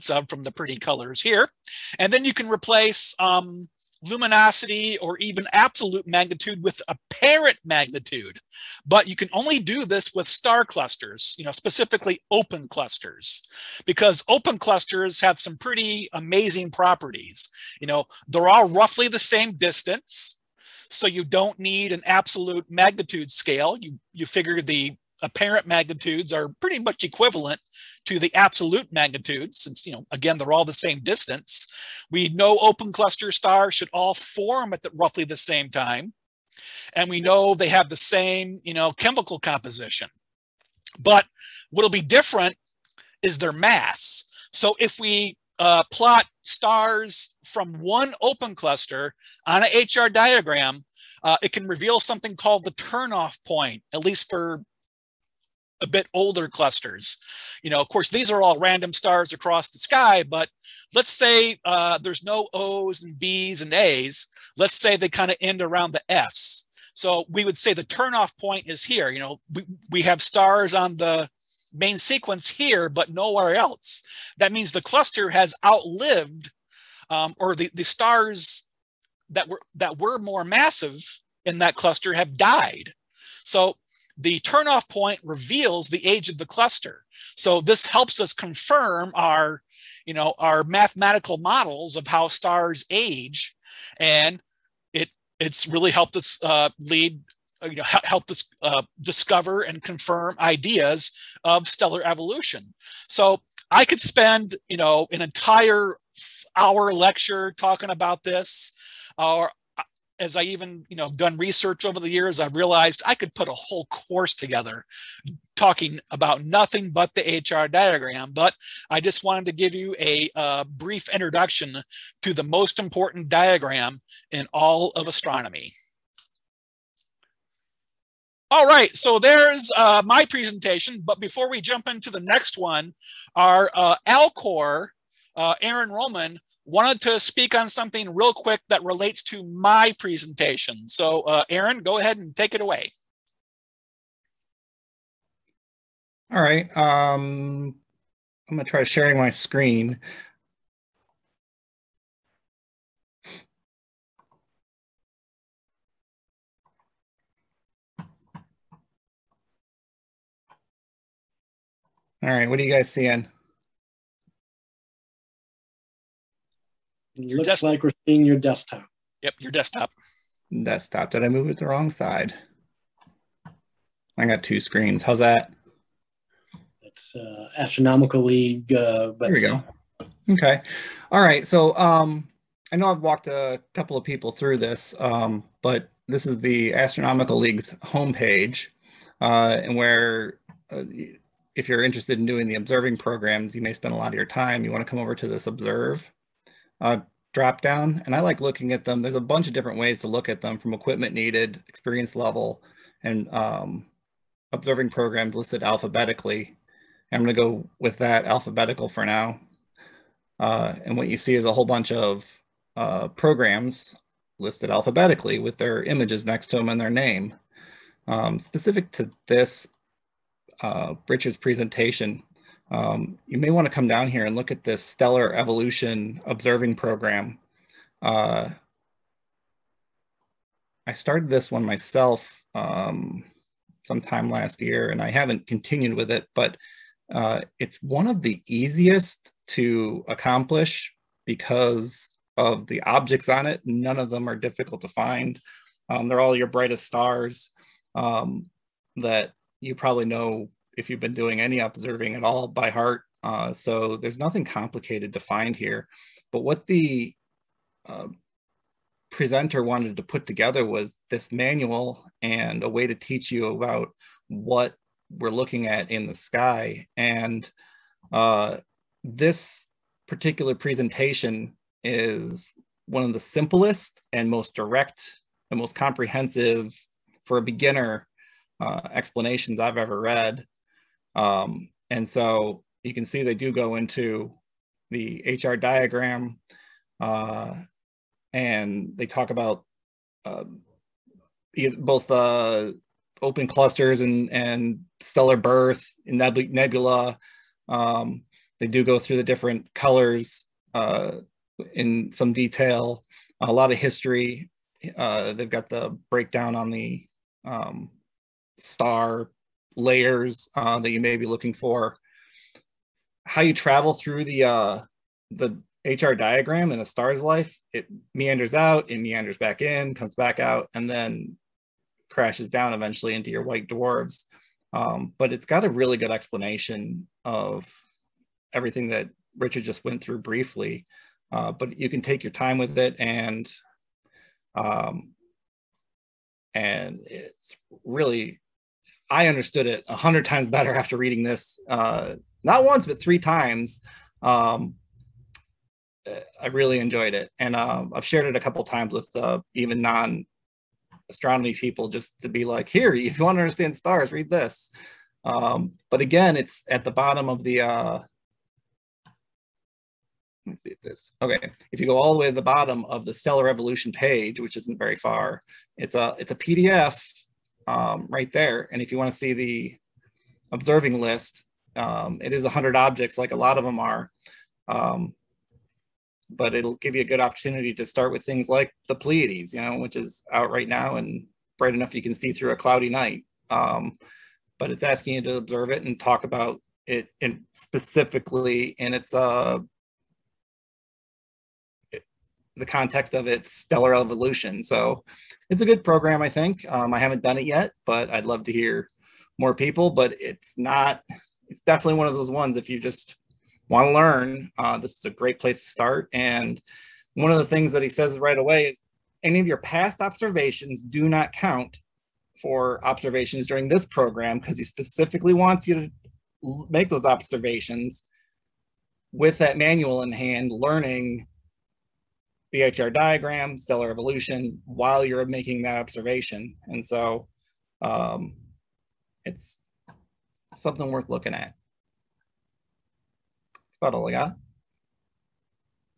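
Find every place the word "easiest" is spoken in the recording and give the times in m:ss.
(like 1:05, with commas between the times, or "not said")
3:58.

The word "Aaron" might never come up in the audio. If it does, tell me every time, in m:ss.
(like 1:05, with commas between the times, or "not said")
2:15, 2:21.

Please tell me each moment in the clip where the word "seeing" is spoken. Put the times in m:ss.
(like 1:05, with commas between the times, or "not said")
2:42, 2:48.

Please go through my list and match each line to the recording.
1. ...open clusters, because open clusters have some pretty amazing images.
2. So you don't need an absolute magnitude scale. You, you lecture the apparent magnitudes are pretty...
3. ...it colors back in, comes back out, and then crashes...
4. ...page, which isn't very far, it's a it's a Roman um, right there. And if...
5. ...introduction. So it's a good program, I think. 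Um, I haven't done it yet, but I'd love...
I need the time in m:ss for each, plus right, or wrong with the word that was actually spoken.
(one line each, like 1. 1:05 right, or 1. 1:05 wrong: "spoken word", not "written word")
1. 0:12 wrong: "properties", not "images"
2. 0:20 wrong: "figure", not "lecture"
3. 5:18 wrong: "meanders", not "colors"
4. 6:03 wrong: "PDF", not "Roman"
5. 6:33 wrong: "evolution", not "introduction".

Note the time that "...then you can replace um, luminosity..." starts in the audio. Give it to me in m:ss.
0:02.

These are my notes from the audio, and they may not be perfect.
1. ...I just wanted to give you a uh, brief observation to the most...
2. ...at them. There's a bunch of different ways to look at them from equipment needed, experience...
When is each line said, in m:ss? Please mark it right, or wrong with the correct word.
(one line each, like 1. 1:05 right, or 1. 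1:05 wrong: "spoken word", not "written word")
1. 1:58 wrong: "introduction", not "observation"
2. 3:18 right.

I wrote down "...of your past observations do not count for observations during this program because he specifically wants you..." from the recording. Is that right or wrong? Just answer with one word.
right.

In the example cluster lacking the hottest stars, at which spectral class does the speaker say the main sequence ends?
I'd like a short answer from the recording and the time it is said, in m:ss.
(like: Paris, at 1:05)
F, at 1:06.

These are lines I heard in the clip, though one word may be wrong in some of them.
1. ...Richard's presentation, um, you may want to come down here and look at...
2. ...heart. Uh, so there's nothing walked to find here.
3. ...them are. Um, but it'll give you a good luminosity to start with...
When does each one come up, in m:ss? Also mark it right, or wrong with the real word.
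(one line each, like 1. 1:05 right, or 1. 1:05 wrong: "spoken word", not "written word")
1. 3:41 right
2. 4:12 wrong: "complicated", not "walked"
3. 6:13 wrong: "opportunity", not "luminosity".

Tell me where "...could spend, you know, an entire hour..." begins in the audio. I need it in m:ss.
1:43.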